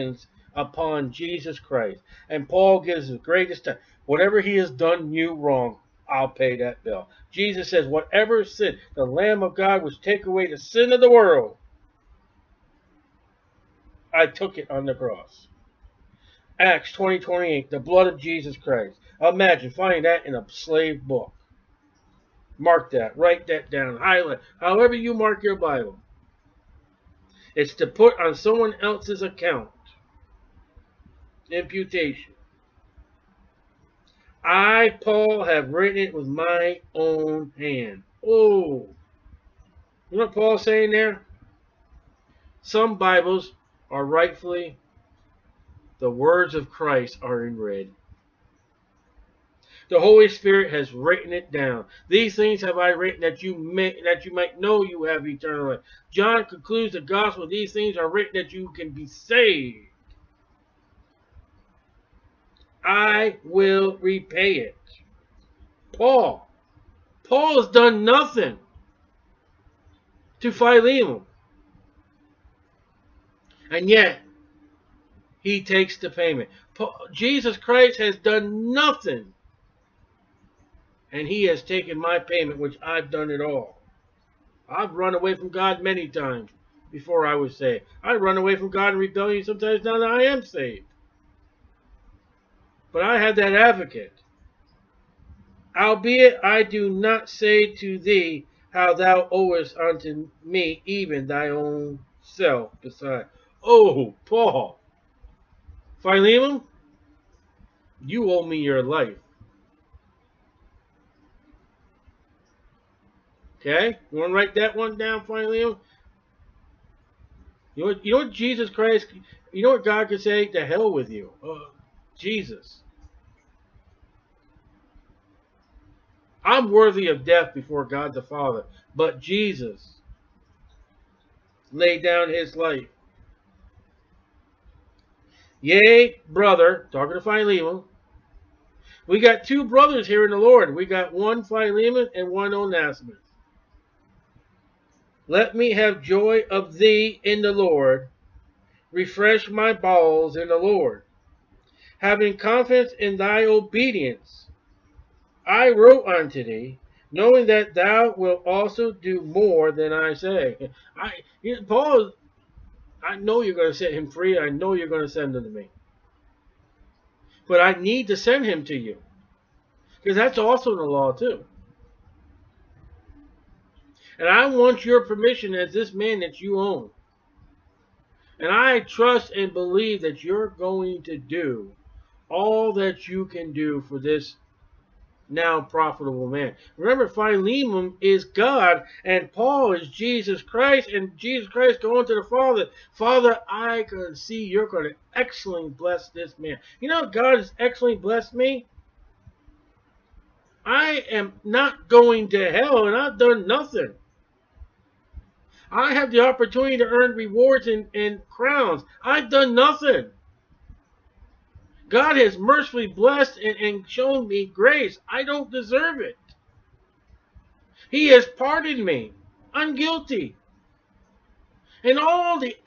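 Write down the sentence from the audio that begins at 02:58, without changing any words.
And I trust and believe that you're going to do all that you can do for this now profitable man.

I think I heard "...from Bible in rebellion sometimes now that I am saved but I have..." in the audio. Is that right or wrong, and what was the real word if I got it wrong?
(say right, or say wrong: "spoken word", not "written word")
wrong: "God", not "Bible".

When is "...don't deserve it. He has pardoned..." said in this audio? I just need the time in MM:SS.
03:35.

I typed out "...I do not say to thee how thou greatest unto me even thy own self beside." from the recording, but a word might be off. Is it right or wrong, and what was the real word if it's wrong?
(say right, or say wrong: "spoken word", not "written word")
wrong: "owest", not "greatest".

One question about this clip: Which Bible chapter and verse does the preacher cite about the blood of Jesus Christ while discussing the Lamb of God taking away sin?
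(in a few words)
Acts 20:28.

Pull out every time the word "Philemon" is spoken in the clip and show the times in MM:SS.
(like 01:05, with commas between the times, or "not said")
01:10, 01:45, 01:55, 02:17, 02:21, 03:07.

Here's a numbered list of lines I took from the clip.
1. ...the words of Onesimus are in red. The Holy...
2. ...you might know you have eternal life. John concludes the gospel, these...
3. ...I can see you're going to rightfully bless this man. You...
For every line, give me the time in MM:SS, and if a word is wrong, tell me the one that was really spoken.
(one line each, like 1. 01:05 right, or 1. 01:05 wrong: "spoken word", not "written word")
1. 00:45 wrong: "Christ", not "Onesimus"
2. 00:54 right
3. 03:13 wrong: "excellently", not "rightfully".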